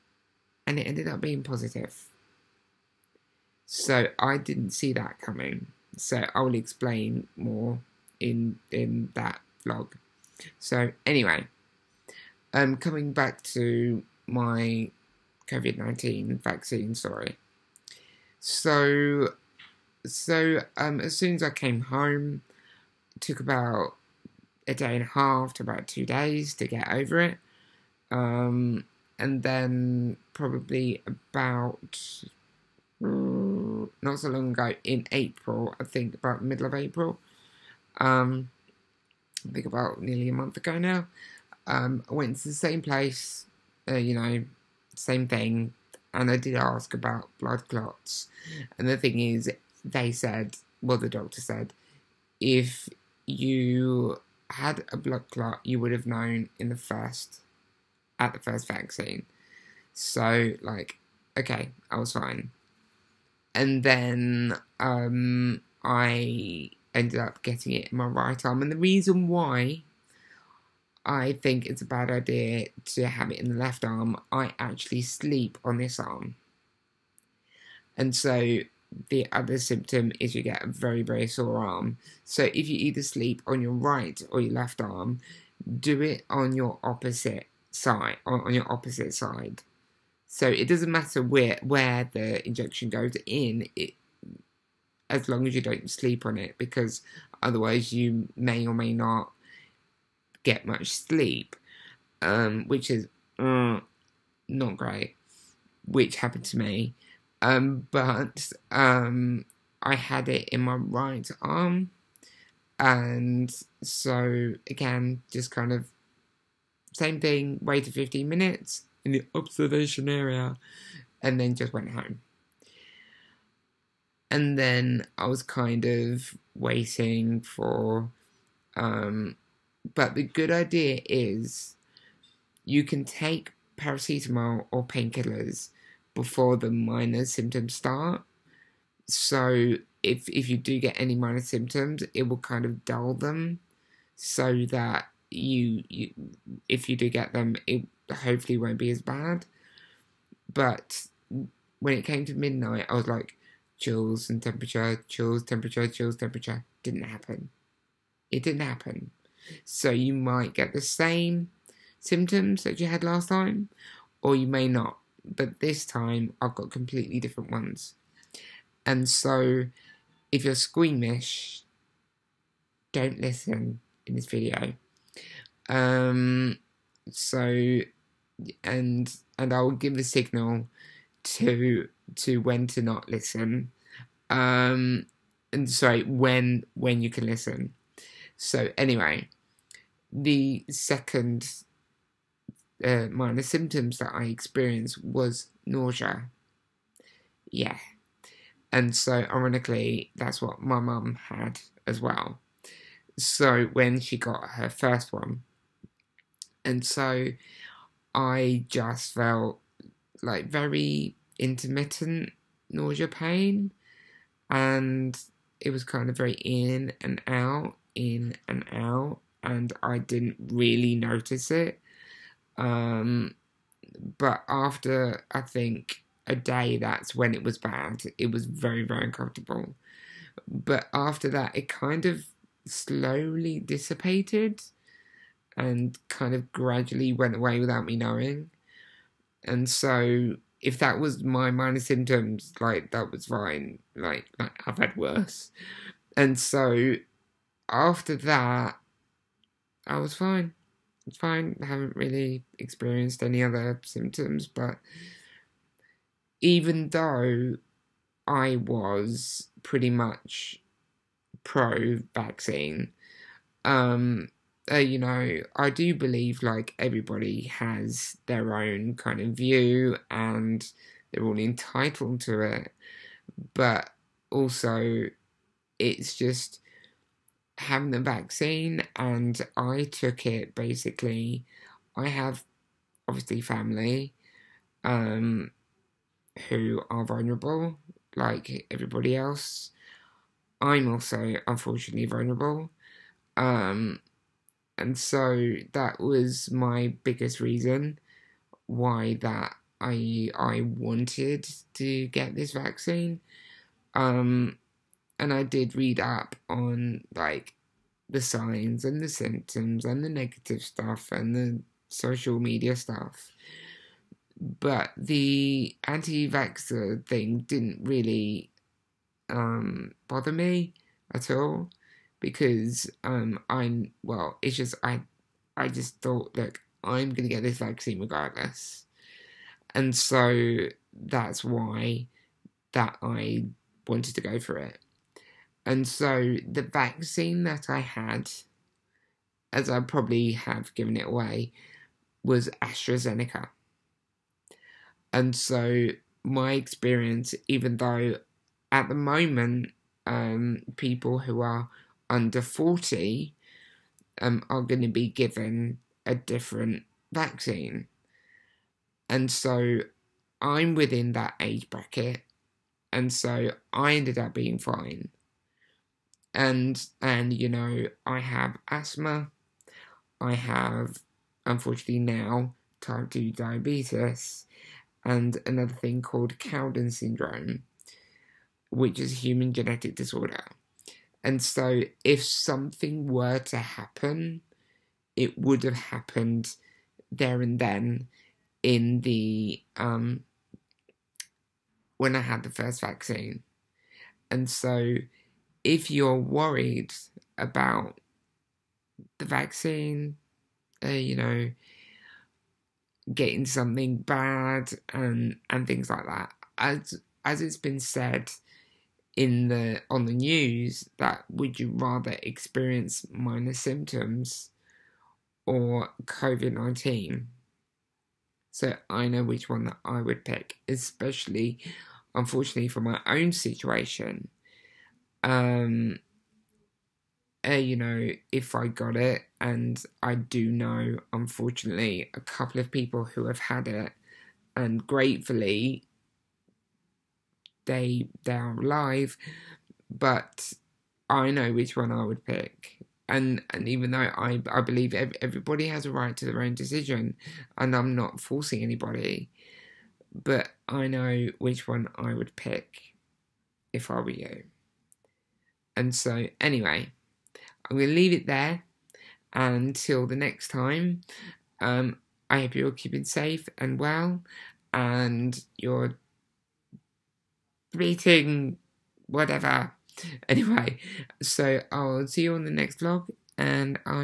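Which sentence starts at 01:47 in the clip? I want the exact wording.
Um, but um, I had it in my right arm, and so again, just kind of same thing.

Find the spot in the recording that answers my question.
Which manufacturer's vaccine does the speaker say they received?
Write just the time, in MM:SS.
05:42.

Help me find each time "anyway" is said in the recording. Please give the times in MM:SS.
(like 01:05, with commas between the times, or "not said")
00:11, 03:08, 07:36, 07:50.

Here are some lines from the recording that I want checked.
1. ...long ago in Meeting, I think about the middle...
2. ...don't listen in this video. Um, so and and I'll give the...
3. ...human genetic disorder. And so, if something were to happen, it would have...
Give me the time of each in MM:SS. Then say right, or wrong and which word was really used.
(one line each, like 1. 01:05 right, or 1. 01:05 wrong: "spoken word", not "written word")
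1. 00:34 wrong: "April", not "Meeting"
2. 02:52 right
3. 06:19 right.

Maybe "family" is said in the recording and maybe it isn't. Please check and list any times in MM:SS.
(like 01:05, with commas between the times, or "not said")
04:43.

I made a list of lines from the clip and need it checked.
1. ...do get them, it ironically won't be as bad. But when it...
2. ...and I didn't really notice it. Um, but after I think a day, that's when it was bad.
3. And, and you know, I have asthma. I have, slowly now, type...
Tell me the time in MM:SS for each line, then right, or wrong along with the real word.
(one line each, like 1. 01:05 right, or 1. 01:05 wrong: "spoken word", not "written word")
1. 02:26 wrong: "hopefully", not "ironically"
2. 03:39 right
3. 06:06 wrong: "unfortunately", not "slowly".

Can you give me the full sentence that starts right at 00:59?
So, like, okay, I was fine and then um, I ended up getting it in my right arm.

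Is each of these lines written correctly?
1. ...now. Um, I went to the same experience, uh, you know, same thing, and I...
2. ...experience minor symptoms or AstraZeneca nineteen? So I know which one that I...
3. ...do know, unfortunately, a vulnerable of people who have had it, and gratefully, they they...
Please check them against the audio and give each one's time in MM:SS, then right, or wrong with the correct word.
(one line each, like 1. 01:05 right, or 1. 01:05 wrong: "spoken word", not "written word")
1. 00:40 wrong: "place", not "experience"
2. 06:52 wrong: "COVID", not "AstraZeneca"
3. 07:10 wrong: "couple", not "vulnerable".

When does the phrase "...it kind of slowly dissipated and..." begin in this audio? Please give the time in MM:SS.
03:51.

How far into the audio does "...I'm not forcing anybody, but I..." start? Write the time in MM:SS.
07:27.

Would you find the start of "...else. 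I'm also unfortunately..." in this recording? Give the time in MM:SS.
04:49.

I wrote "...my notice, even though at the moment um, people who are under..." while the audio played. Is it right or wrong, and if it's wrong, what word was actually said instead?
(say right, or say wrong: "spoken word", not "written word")
wrong: "experience", not "notice".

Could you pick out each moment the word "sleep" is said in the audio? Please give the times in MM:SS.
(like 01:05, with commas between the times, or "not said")
01:15, 01:23, 01:35, 01:40.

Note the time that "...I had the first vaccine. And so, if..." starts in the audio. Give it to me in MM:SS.
06:32.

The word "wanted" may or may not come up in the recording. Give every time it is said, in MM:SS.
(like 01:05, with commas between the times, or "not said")
05:00, 05:33.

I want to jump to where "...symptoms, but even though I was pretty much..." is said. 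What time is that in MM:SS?
04:13.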